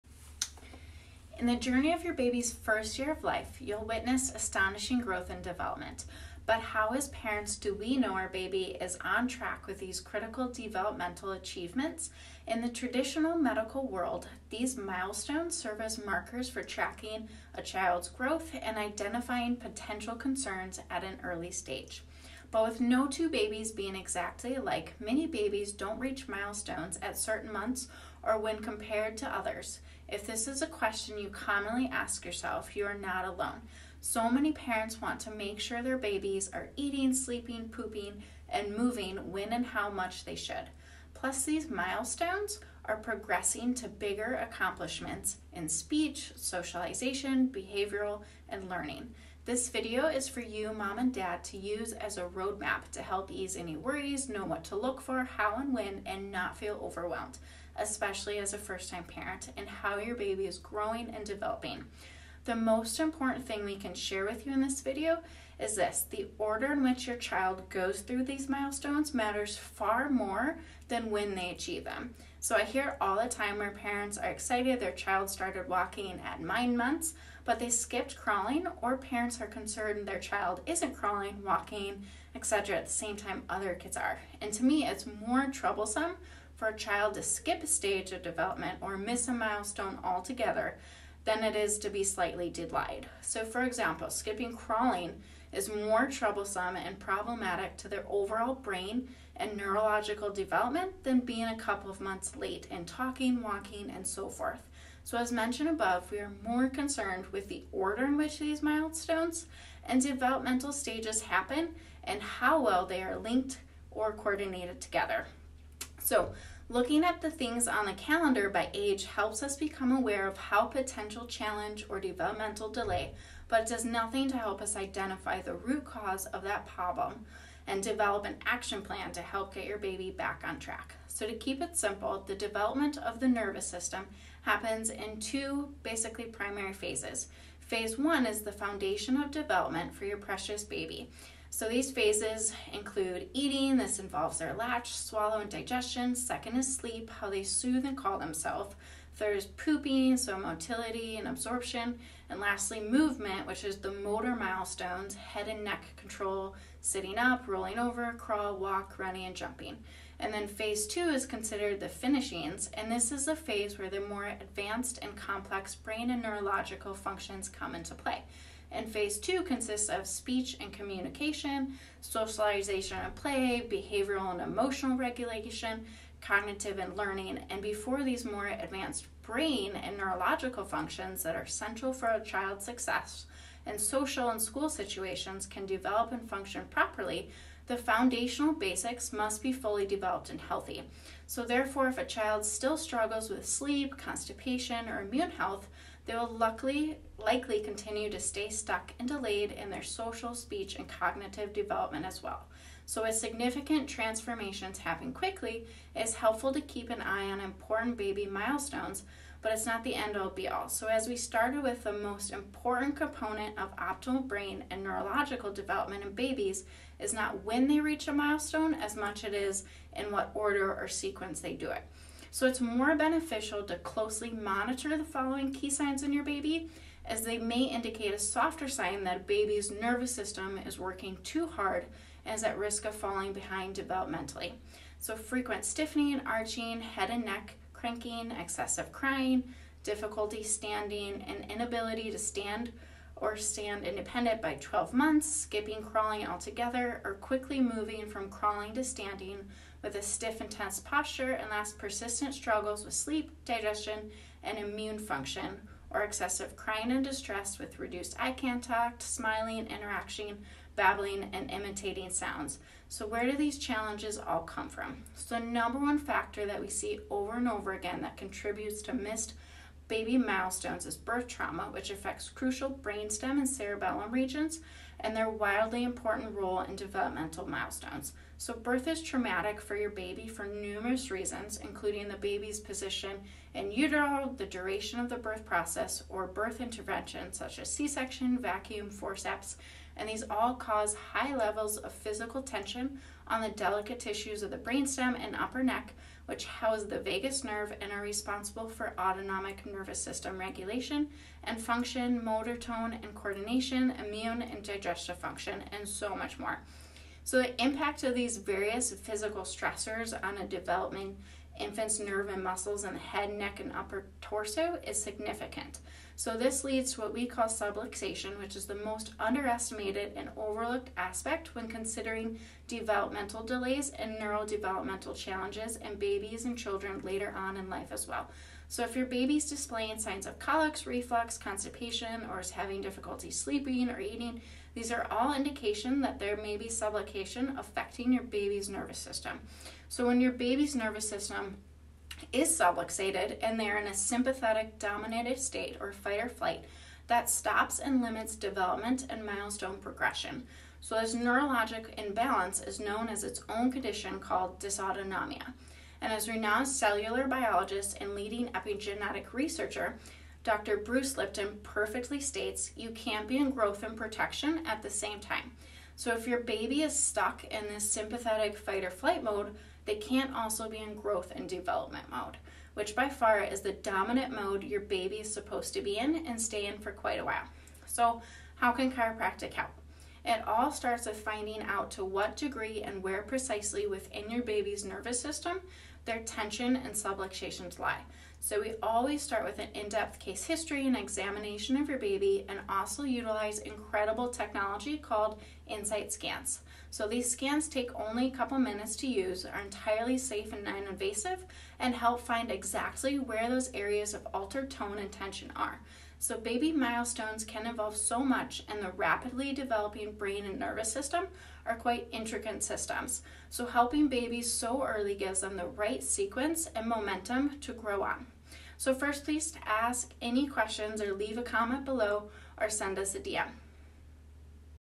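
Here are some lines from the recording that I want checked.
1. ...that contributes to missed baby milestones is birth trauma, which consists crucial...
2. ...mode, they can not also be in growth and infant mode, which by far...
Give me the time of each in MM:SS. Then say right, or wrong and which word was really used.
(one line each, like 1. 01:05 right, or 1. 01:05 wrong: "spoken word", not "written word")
1. 04:28 wrong: "affects", not "consists"
2. 06:09 wrong: "development", not "infant".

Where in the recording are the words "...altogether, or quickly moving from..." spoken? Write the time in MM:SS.
04:06.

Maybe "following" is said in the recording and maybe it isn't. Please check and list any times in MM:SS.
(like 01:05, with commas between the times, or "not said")
03:45.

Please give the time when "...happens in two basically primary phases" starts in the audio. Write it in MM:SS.
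02:14.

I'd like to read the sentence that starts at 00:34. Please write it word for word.
So many parents want to make sure their babies are eating, sleeping, pooping, and moving when and how much they should.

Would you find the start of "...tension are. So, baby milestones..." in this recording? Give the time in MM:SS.
06:45.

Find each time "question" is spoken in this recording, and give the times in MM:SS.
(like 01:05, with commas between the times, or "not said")
00:30, 07:00.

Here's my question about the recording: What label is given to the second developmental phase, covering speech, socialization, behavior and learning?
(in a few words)
The finishings.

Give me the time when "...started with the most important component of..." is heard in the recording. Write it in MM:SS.
03:31.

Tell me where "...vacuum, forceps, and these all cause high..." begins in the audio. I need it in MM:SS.
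04:48.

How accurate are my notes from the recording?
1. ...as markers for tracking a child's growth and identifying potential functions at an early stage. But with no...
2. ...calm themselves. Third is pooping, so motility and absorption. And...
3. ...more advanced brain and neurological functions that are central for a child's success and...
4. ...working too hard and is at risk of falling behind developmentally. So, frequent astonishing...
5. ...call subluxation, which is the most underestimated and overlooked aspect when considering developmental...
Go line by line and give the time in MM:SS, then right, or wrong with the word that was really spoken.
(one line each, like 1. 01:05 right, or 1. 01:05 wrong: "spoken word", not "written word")
1. 00:15 wrong: "concerns", not "functions"
2. 02:27 right
3. 02:58 right
4. 03:50 wrong: "stiffening", not "astonishing"
5. 05:17 right.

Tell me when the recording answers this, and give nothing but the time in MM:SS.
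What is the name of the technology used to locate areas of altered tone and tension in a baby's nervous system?
06:35.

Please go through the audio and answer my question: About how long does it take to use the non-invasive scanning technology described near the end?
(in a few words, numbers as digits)
A couple minutes.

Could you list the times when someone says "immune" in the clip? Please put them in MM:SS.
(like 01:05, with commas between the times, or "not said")
03:15, 04:14, 05:04.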